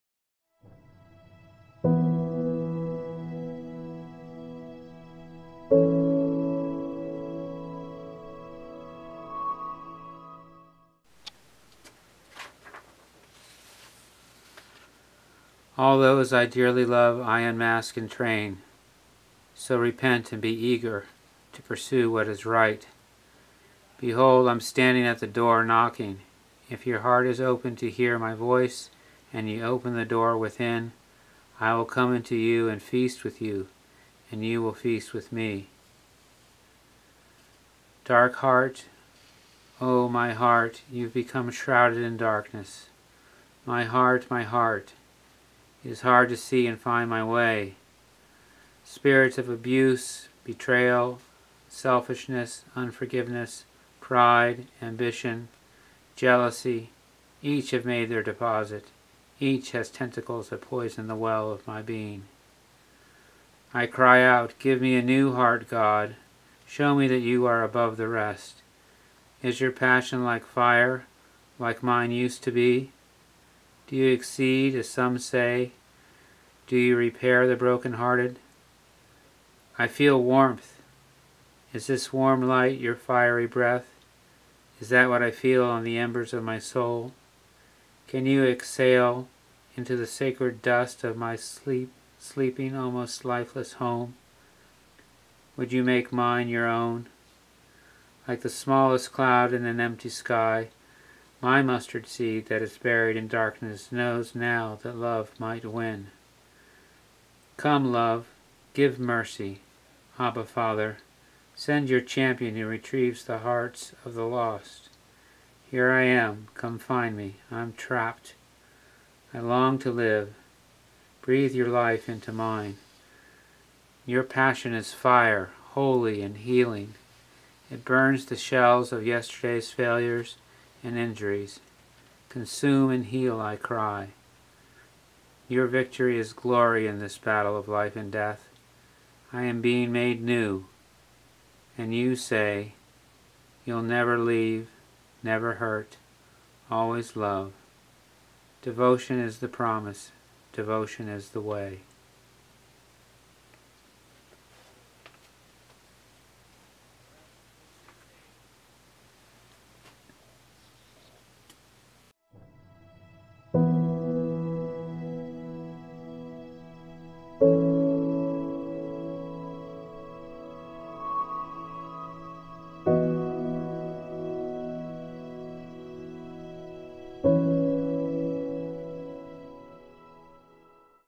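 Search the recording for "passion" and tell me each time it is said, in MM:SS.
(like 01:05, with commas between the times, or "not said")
01:09, 02:04.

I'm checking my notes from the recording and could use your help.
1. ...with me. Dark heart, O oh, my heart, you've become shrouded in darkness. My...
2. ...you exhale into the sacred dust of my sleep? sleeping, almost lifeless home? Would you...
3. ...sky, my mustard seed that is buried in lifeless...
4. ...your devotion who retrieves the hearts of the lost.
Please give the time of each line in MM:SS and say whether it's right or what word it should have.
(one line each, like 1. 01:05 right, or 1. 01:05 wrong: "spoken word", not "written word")
1. 00:35 right
2. 01:28 right
3. 01:40 wrong: "darkness", not "lifeless"
4. 01:51 wrong: "champion", not "devotion".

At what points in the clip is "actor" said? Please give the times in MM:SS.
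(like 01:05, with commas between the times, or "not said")
not said.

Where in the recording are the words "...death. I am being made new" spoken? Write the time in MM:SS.
02:18.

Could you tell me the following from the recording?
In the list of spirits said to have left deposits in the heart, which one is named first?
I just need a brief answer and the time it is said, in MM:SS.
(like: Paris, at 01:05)
Abuse, at 00:49.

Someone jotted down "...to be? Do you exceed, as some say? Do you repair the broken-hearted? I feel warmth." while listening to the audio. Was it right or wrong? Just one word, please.
right.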